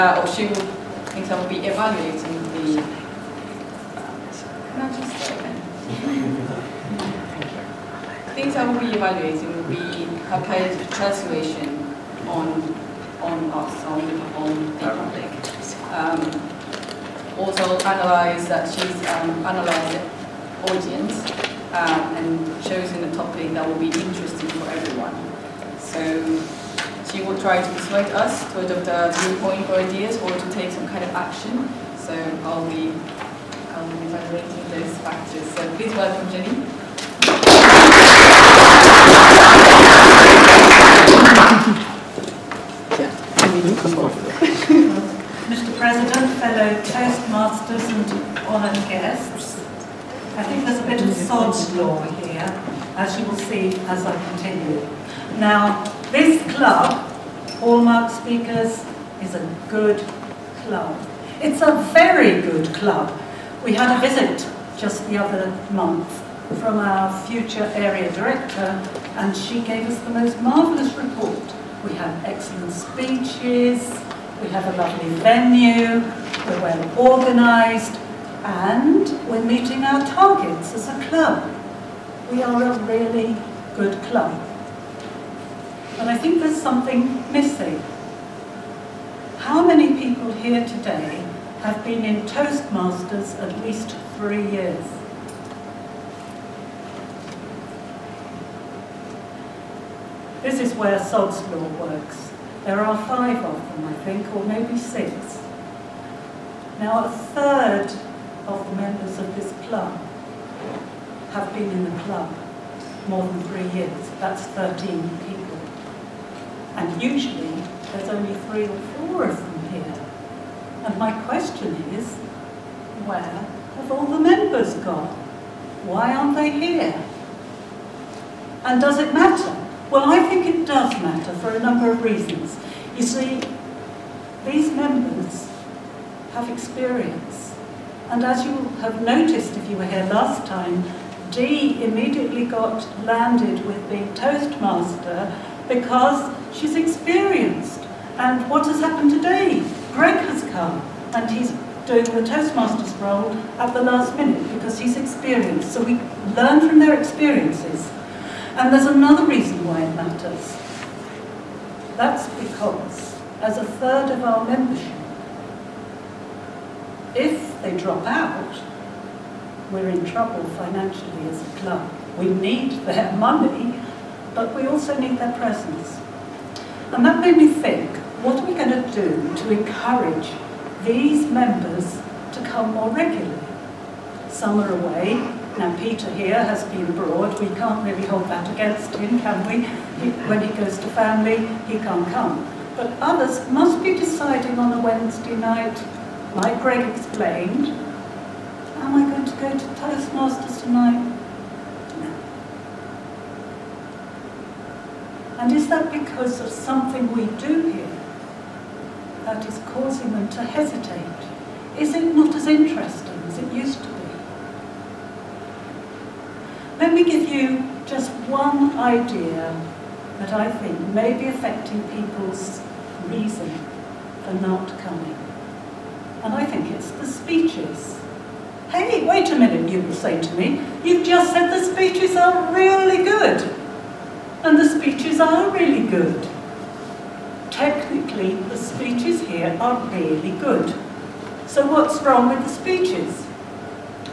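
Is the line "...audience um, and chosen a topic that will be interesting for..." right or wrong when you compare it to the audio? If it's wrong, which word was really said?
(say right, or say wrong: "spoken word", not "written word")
right.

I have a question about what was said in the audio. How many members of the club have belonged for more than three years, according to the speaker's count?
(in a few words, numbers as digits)
13.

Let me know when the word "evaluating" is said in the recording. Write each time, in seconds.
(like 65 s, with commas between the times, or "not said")
1 s, 8 s, 33 s.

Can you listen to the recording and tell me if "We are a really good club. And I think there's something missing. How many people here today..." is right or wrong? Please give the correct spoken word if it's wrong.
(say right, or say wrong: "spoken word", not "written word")
right.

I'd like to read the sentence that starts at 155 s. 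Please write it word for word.
So we learn from their experiences.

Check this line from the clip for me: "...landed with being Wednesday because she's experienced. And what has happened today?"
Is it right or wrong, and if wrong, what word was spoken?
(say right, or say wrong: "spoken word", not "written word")
wrong: "Toastmaster", not "Wednesday".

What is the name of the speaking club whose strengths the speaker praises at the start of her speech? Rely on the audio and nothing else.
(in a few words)
Hallmark Speakers.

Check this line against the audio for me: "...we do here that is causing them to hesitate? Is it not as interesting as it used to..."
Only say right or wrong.
right.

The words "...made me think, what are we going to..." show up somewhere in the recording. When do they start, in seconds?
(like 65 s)
177 s.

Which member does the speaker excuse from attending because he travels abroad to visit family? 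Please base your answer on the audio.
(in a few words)
Peter.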